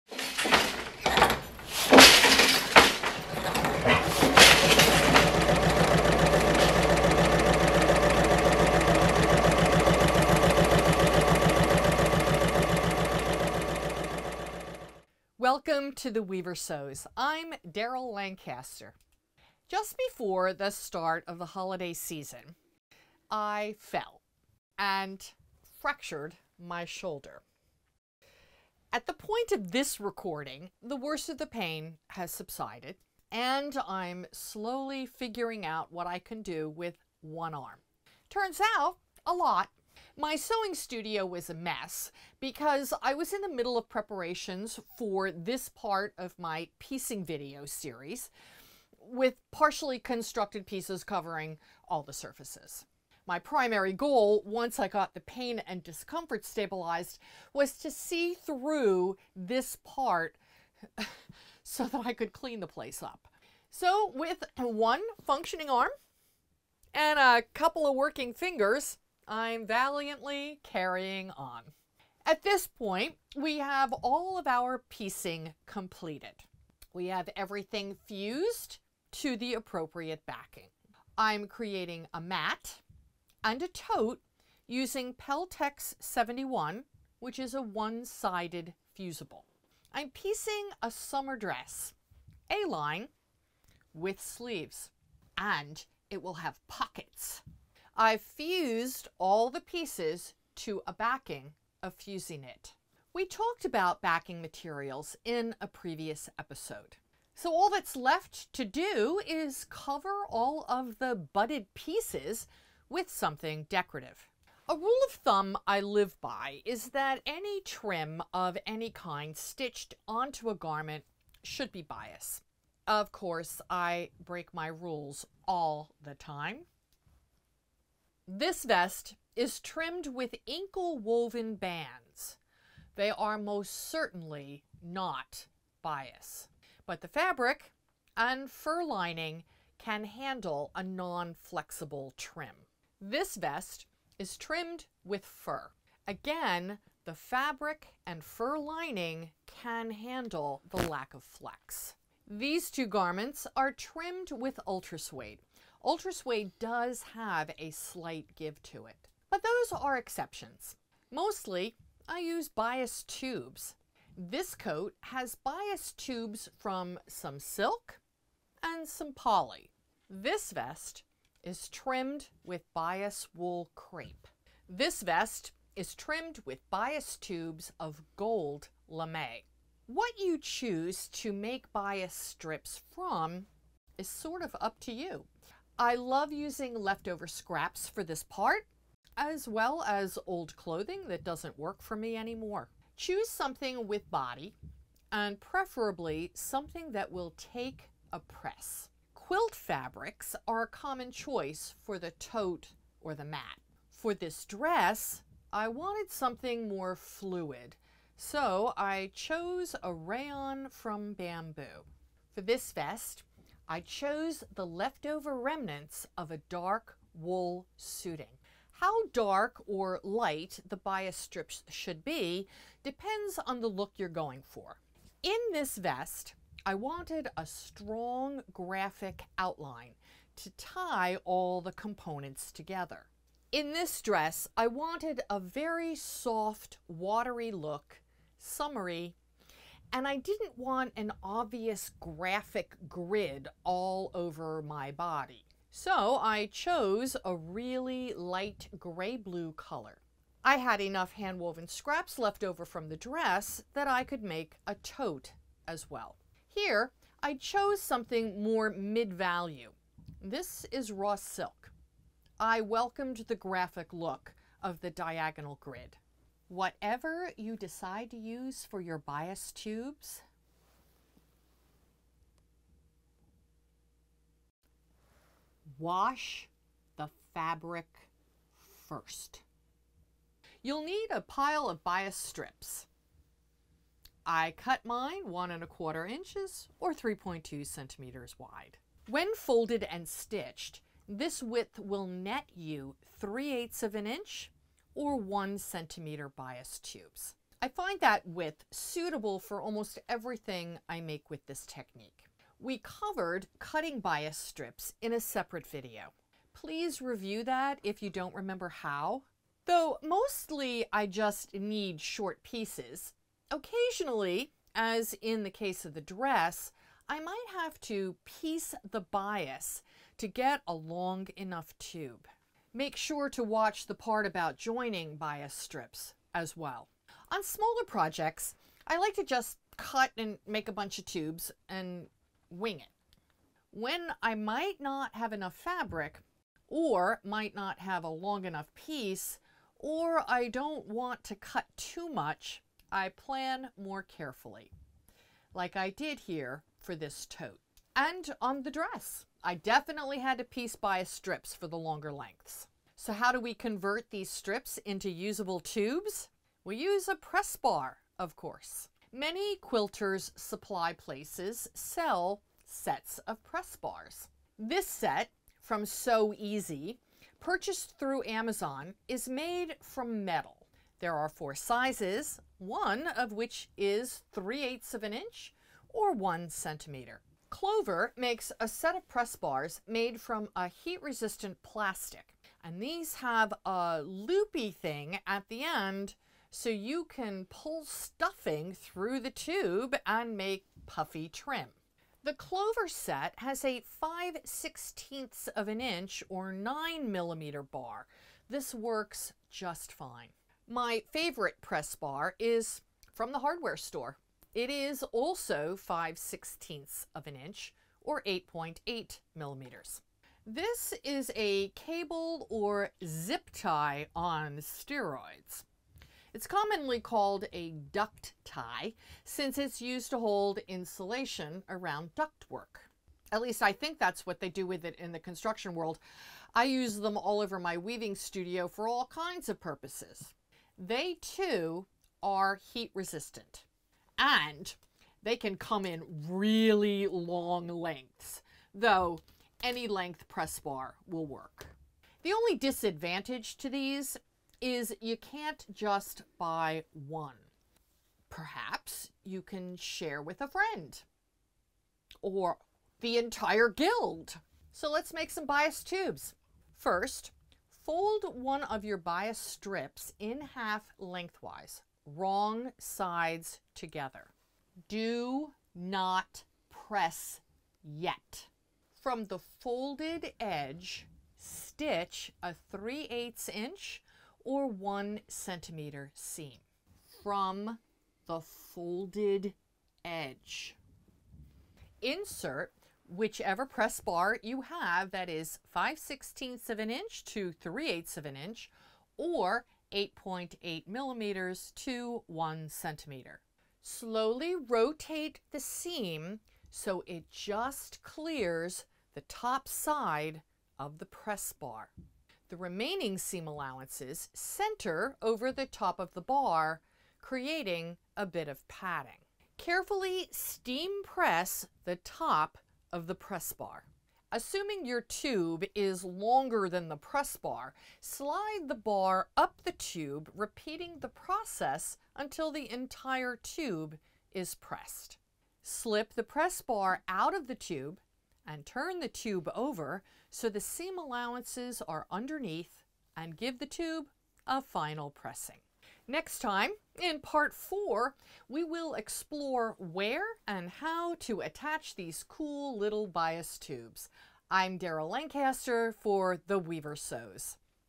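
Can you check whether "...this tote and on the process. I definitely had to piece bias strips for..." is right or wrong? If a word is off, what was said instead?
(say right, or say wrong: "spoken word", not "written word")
wrong: "dress", not "process".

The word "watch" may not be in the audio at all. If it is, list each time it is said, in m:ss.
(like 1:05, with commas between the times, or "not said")
5:23.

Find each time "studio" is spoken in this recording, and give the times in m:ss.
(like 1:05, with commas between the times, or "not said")
0:40, 7:08.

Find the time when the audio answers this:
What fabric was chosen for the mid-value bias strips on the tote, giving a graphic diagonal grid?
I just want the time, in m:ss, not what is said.
4:20.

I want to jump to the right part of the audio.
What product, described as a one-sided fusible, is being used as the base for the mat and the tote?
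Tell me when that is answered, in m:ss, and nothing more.
1:25.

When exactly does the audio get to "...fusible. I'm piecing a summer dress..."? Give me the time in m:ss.
1:28.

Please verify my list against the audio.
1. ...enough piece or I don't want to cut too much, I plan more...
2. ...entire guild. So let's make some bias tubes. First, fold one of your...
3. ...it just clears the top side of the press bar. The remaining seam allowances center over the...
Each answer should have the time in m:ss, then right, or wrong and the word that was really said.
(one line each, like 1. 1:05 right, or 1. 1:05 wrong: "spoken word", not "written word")
1. 5:38 right
2. 7:33 right
3. 8:17 right.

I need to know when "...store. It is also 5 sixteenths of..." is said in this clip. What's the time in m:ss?
6:43.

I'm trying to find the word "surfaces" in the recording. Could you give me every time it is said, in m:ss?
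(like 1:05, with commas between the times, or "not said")
0:52.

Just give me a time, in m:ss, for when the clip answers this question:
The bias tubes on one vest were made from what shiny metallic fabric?
2:58.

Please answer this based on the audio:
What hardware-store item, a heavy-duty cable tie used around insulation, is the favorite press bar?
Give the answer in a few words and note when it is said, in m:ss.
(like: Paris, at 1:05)
Duct tie, at 6:57.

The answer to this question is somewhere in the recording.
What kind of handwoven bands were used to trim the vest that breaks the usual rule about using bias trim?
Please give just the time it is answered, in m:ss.
2:10.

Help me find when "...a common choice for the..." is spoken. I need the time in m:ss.
3:20.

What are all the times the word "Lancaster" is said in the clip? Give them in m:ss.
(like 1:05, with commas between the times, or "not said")
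0:18, 9:05.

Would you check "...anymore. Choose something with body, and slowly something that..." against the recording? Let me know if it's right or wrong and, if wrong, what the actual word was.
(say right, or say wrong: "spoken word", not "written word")
wrong: "preferably", not "slowly".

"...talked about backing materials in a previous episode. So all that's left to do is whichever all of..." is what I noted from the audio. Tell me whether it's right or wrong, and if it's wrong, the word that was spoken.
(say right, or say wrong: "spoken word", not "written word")
wrong: "cover", not "whichever".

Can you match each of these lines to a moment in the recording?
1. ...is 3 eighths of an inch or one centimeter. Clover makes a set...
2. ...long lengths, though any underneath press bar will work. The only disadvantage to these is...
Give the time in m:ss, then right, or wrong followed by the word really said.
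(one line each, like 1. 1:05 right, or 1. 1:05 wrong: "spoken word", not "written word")
1. 6:13 right
2. 7:17 wrong: "length", not "underneath".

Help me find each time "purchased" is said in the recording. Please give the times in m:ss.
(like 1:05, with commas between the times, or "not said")
6:07.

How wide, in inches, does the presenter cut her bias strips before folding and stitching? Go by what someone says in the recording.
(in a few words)
1 1/4 inches.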